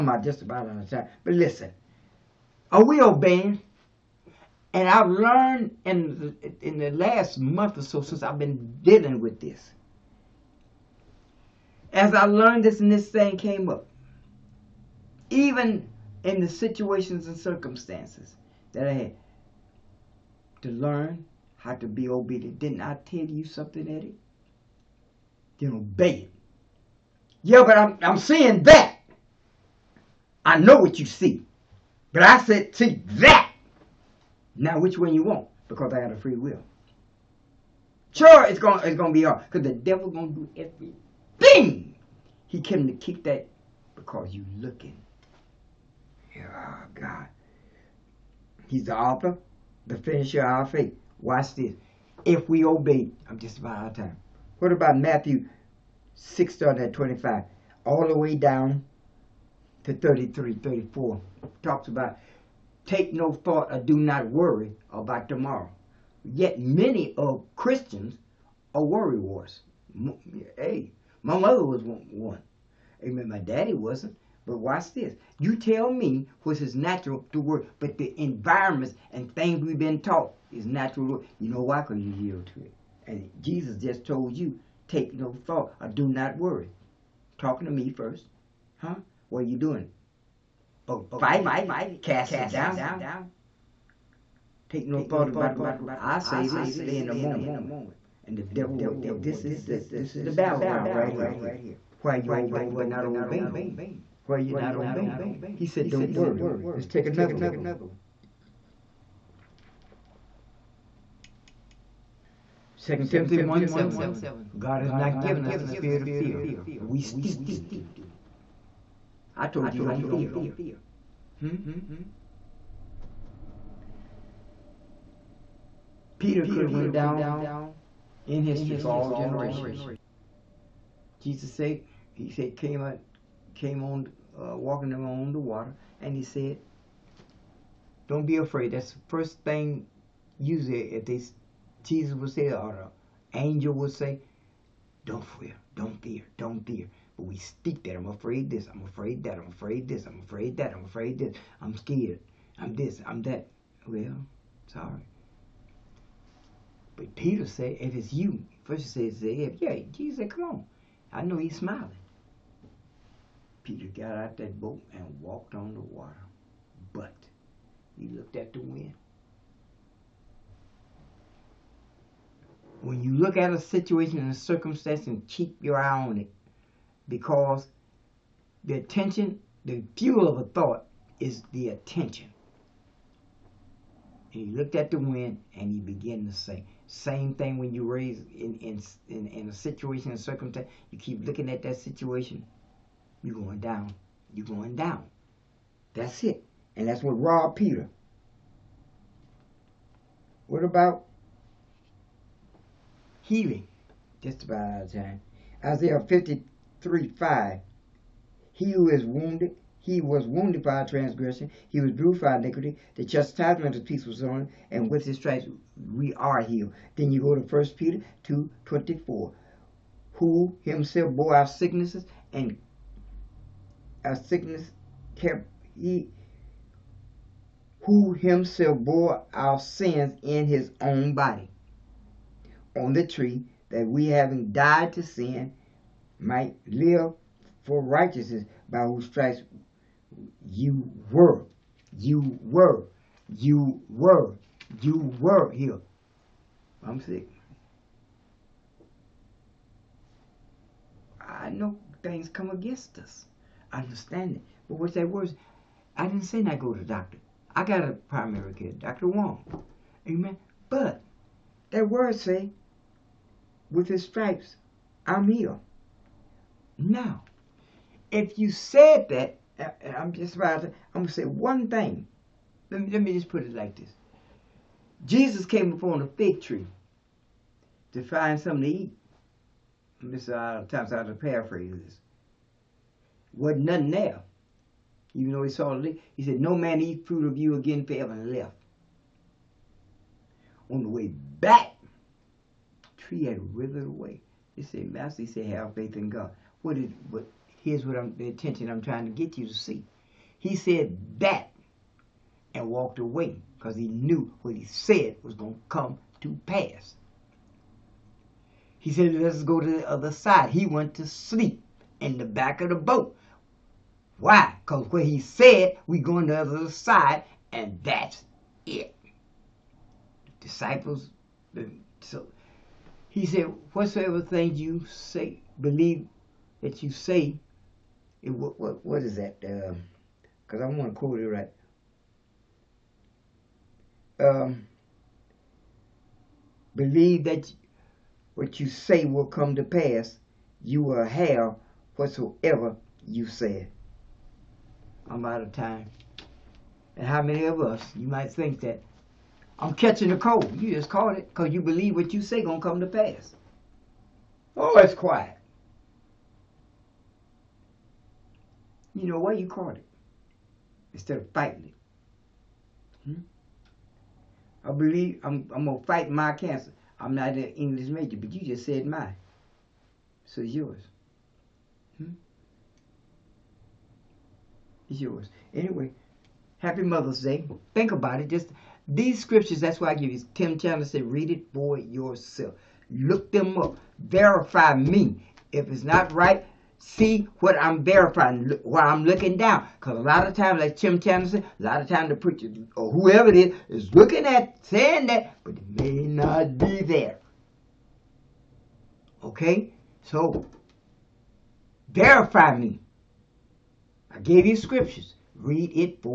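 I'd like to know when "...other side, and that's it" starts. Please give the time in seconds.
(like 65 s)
316 s.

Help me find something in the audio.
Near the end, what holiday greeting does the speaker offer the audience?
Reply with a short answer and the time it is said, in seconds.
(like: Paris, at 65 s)
Mother's Day, at 376 s.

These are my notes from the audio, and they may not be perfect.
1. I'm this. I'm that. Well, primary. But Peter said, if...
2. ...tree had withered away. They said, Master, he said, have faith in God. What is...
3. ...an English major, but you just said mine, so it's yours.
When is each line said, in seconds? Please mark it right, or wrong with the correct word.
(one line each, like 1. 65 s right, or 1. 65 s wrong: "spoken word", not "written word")
1. 152 s wrong: "sorry", not "primary"
2. 293 s right
3. 367 s right.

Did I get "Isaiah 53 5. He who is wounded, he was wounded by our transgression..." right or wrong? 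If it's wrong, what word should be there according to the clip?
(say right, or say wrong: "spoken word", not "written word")
right.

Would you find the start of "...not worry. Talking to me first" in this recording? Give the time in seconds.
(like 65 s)
86 s.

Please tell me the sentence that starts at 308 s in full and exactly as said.
He said, let's go to the other side.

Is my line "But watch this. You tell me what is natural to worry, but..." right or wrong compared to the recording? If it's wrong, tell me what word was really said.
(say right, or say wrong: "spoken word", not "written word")
right.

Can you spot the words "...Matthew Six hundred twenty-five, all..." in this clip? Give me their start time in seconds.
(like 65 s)
54 s.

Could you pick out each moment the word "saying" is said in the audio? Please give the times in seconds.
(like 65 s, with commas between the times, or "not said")
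394 s.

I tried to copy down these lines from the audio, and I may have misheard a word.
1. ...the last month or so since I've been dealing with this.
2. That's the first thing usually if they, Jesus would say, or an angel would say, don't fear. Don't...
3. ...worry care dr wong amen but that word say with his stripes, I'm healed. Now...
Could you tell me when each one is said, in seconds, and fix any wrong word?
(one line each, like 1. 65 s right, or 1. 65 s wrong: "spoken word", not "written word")
1. 6 s right
2. 138 s right
3. 257 s wrong: "primary", not "worry".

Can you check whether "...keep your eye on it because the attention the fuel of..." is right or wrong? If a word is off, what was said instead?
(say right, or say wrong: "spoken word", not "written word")
right.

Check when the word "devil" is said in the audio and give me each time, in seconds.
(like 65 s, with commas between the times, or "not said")
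39 s, 98 s.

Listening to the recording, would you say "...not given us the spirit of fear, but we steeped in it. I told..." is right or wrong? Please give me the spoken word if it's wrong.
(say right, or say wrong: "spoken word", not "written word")
right.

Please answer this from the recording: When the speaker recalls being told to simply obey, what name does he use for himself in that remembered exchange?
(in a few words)
Eddie.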